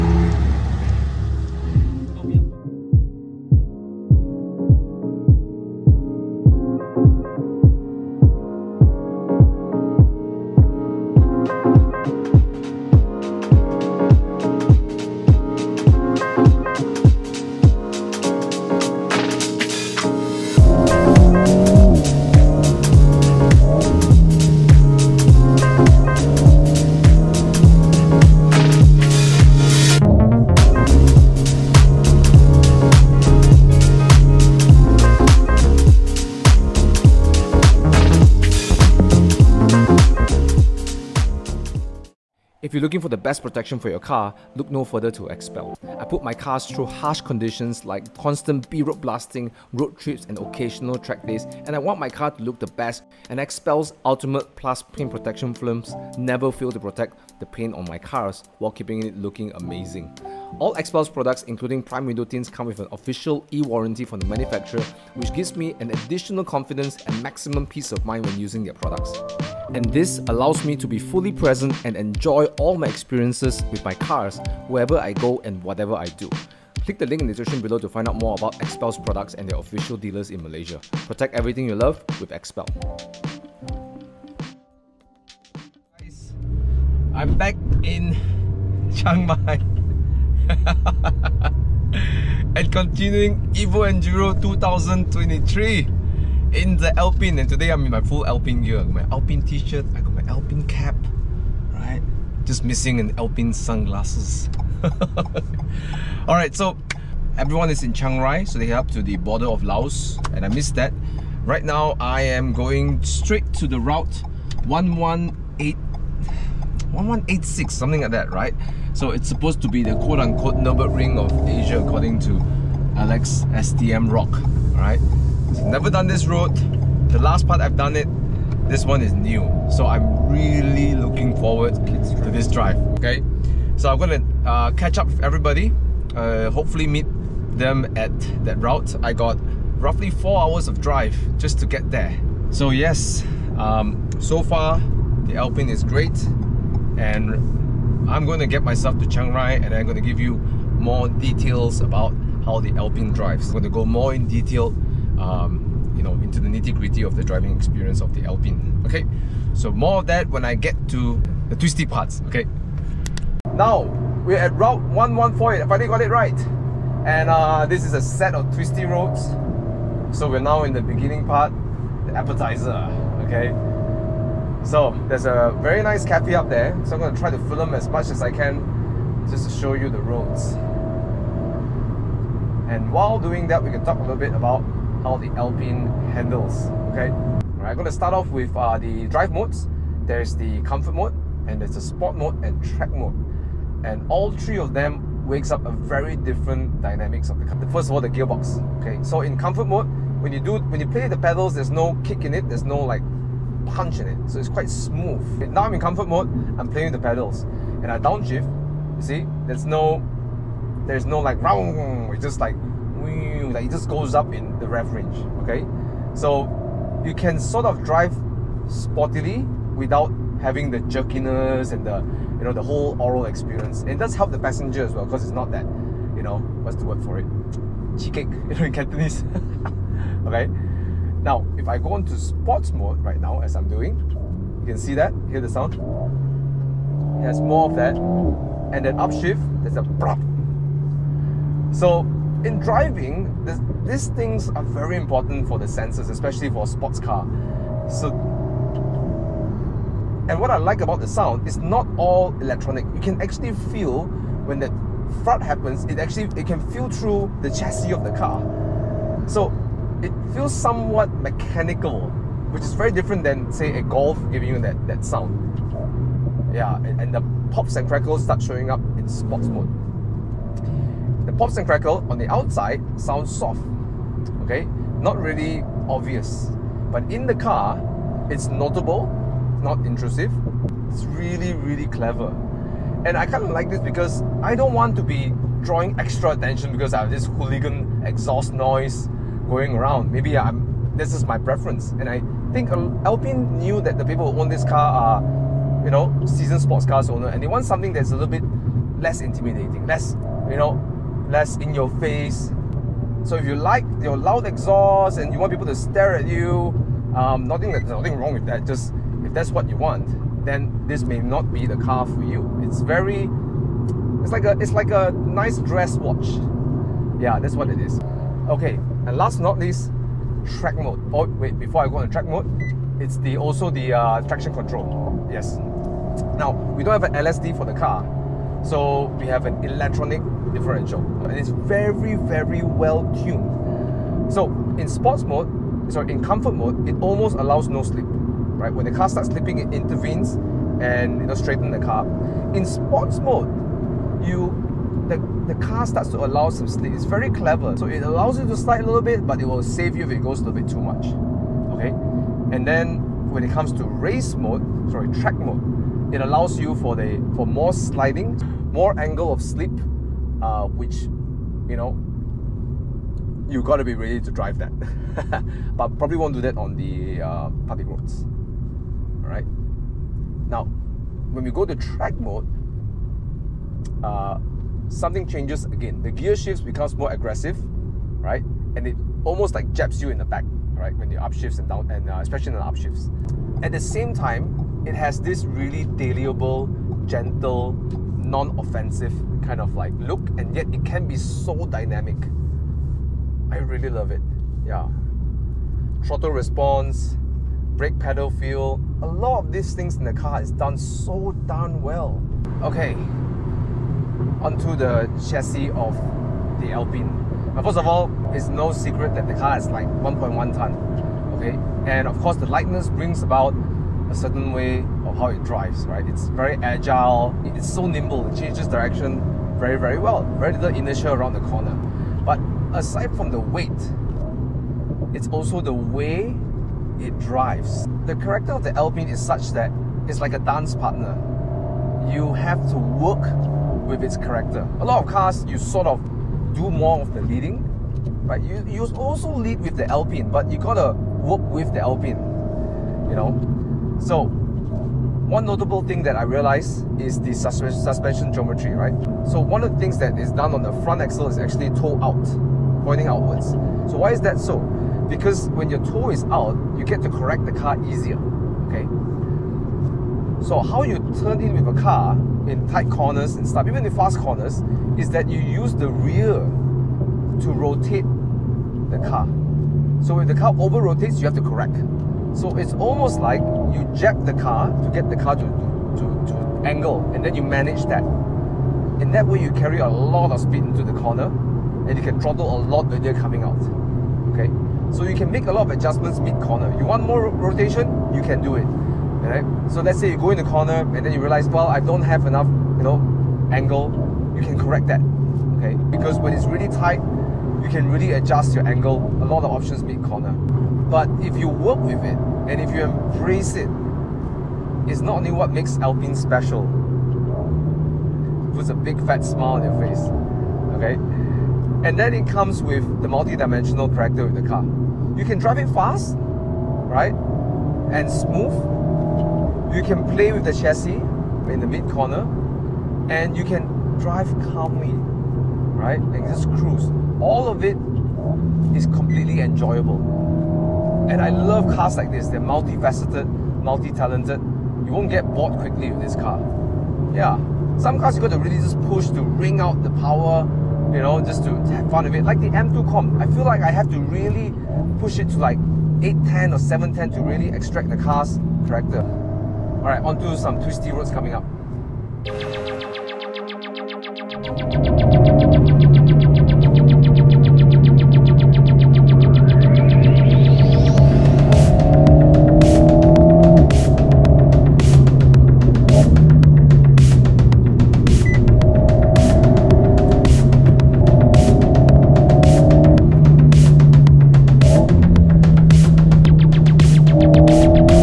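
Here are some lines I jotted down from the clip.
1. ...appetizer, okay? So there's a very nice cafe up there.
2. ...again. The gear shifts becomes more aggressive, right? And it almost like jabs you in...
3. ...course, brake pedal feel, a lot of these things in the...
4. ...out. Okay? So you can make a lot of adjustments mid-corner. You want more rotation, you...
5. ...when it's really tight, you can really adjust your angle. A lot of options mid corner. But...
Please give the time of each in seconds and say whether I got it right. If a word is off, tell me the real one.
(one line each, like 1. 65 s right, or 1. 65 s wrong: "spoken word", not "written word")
1. 172 s right
2. 375 s right
3. 396 s wrong: "response", not "course"
4. 483 s right
5. 496 s right.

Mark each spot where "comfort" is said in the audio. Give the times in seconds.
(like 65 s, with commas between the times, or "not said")
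190 s, 199 s, 205 s, 336 s.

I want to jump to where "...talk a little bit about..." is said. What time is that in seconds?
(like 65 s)
183 s.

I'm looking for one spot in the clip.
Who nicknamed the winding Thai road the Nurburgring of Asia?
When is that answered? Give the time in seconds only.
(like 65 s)
122 s.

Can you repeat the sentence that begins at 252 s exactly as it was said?
You can actually feel when the thud happens.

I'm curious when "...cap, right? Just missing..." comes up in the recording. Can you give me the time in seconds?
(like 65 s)
100 s.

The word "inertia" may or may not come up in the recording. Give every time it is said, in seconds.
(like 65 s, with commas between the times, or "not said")
420 s.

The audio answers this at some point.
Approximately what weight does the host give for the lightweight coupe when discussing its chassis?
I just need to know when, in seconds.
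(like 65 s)
409 s.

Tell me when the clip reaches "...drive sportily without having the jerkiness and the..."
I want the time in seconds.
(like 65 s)
217 s.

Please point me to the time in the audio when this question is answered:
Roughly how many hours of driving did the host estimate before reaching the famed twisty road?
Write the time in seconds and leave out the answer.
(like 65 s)
140 s.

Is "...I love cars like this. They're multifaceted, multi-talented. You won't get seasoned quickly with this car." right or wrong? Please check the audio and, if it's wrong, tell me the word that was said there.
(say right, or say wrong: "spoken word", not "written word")
wrong: "bored", not "seasoned".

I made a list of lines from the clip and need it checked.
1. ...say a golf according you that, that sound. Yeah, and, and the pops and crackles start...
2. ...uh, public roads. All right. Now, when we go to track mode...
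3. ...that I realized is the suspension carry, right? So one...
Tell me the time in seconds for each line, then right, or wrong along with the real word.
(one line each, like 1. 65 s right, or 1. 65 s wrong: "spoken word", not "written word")
1. 263 s wrong: "giving", not "according"
2. 367 s right
3. 446 s wrong: "geometry", not "carry".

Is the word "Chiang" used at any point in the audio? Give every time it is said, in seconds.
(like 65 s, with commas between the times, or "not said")
88 s, 107 s, 149 s.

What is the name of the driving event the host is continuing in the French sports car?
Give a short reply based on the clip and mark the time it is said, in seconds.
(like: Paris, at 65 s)
Evo Enduro 2023, at 93 s.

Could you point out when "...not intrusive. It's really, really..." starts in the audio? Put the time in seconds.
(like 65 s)
279 s.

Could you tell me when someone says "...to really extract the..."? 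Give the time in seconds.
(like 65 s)
547 s.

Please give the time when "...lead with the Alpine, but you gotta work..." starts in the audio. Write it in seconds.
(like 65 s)
439 s.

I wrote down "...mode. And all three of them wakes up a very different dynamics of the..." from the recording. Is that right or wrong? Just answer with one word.
right.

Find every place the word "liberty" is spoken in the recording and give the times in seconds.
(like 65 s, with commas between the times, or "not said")
not said.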